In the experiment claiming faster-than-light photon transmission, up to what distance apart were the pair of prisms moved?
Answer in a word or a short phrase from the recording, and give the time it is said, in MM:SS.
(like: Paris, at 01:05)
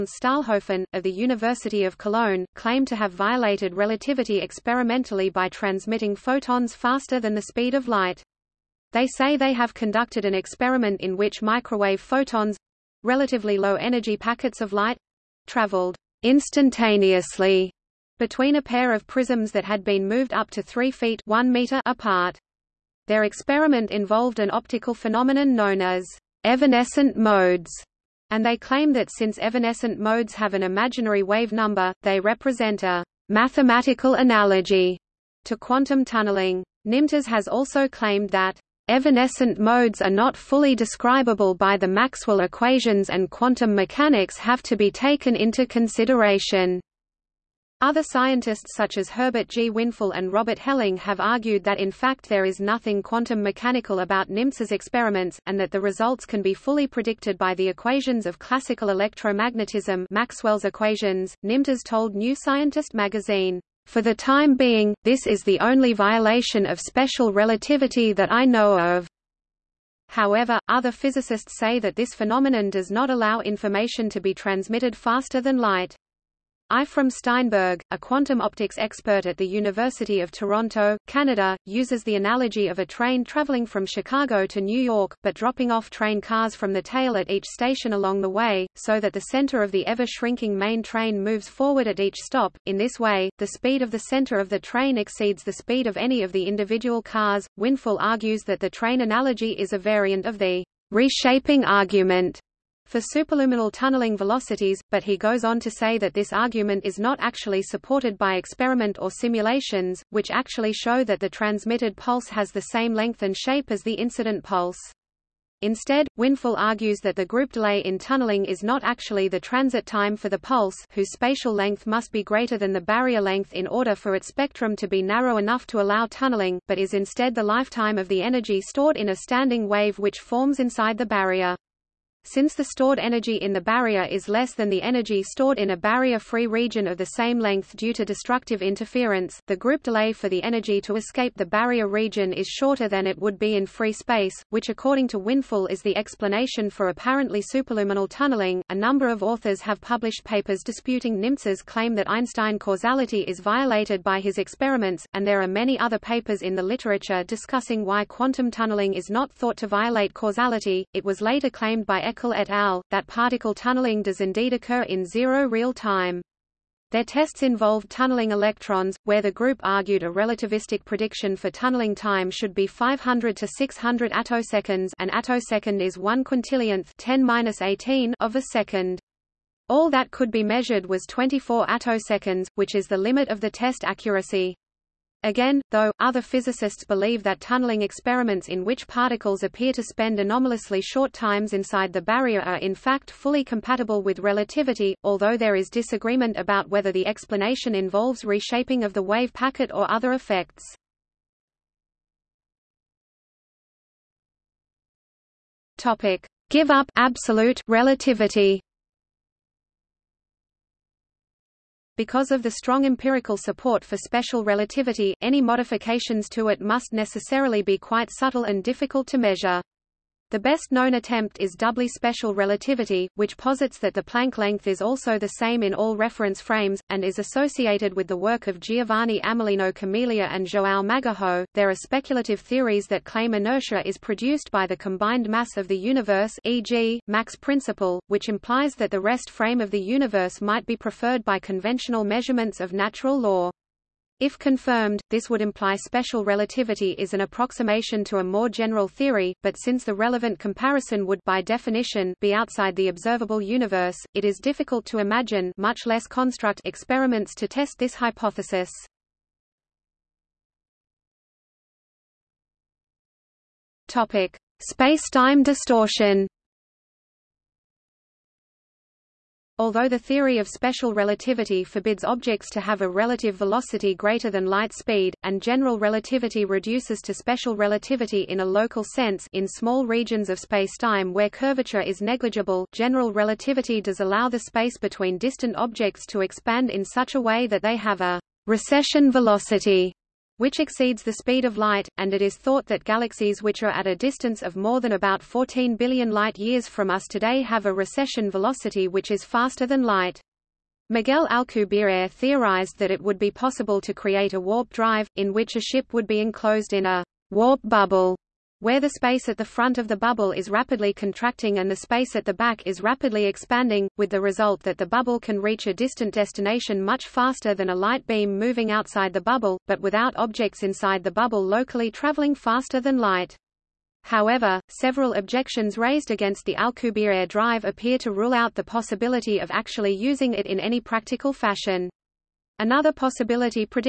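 1 meter, at 00:21.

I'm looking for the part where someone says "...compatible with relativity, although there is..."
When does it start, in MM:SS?
03:13.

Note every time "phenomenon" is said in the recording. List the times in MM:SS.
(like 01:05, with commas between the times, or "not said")
00:24, 01:12.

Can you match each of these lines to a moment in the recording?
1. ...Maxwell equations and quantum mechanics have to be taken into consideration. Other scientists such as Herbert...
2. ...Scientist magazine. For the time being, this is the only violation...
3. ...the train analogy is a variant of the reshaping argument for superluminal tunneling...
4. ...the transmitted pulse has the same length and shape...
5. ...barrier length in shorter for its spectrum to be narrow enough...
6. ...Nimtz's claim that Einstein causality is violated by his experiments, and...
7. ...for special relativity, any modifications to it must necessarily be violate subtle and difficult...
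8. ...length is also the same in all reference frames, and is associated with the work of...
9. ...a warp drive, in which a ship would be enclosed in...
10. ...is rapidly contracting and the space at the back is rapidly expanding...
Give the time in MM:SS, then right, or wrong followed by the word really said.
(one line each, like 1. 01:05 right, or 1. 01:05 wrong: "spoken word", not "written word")
1. 00:41 right
2. 01:02 right
3. 01:38 right
4. 01:51 right
5. 02:02 wrong: "order", not "shorter"
6. 02:31 right
7. 03:33 wrong: "quite", not "violate"
8. 03:44 right
9. 05:04 right
10. 05:10 right.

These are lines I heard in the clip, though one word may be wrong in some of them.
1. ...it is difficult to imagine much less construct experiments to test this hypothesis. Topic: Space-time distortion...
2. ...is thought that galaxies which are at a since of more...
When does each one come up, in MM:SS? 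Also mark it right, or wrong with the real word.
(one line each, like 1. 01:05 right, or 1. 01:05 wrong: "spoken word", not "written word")
1. 04:14 right
2. 04:52 wrong: "distance", not "since".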